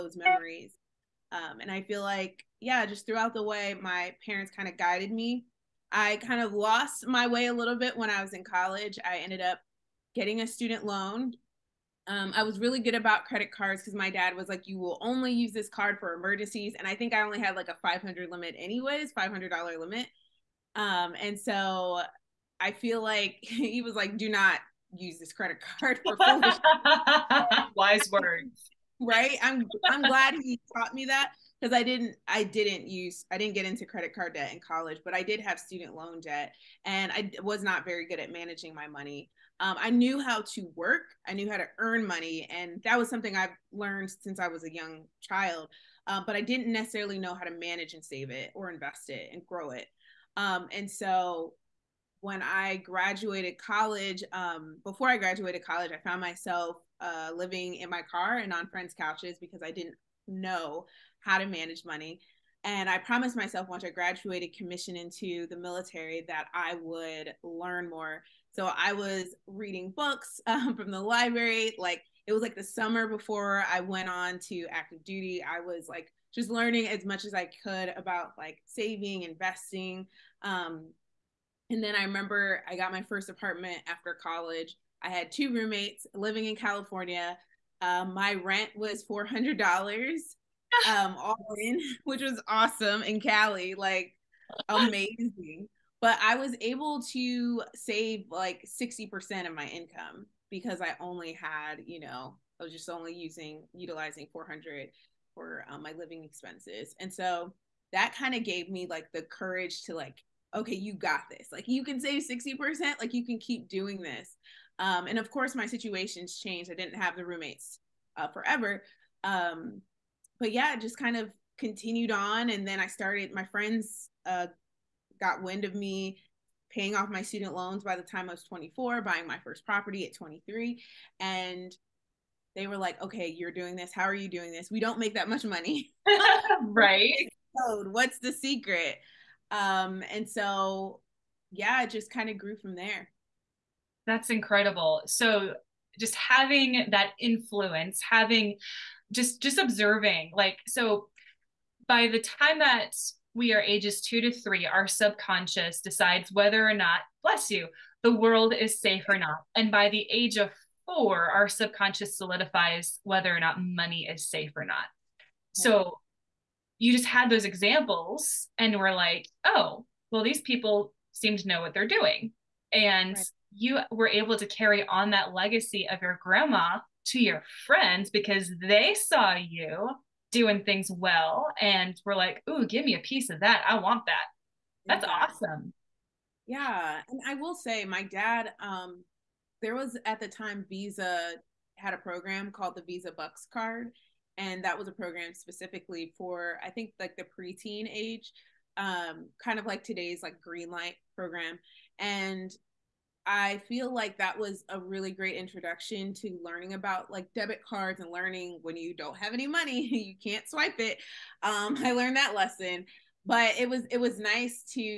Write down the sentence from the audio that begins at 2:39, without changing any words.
And by the age of four, our subconscious solidifies whether or not money is safe or not.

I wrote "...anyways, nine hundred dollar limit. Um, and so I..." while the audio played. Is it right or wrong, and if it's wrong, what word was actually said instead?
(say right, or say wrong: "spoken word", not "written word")
wrong: "five", not "nine".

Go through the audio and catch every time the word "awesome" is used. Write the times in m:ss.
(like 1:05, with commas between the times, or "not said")
1:32, 3:05.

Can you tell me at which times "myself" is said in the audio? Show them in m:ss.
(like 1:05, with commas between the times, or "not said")
0:56, 1:03.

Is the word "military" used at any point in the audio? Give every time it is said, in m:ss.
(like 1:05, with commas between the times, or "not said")
1:05.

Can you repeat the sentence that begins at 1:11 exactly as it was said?
Like it was like the summer before I went on to active duty.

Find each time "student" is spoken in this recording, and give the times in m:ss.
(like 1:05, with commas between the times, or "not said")
0:10, 0:35, 2:07.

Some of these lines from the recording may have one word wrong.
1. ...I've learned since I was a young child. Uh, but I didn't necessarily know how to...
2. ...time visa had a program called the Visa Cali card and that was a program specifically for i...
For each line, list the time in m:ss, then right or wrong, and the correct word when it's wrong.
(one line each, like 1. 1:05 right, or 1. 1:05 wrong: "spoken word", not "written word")
1. 0:43 right
2. 3:10 wrong: "Buxx", not "Cali".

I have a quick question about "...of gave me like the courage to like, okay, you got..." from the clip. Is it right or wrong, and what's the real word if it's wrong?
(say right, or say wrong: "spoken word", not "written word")
right.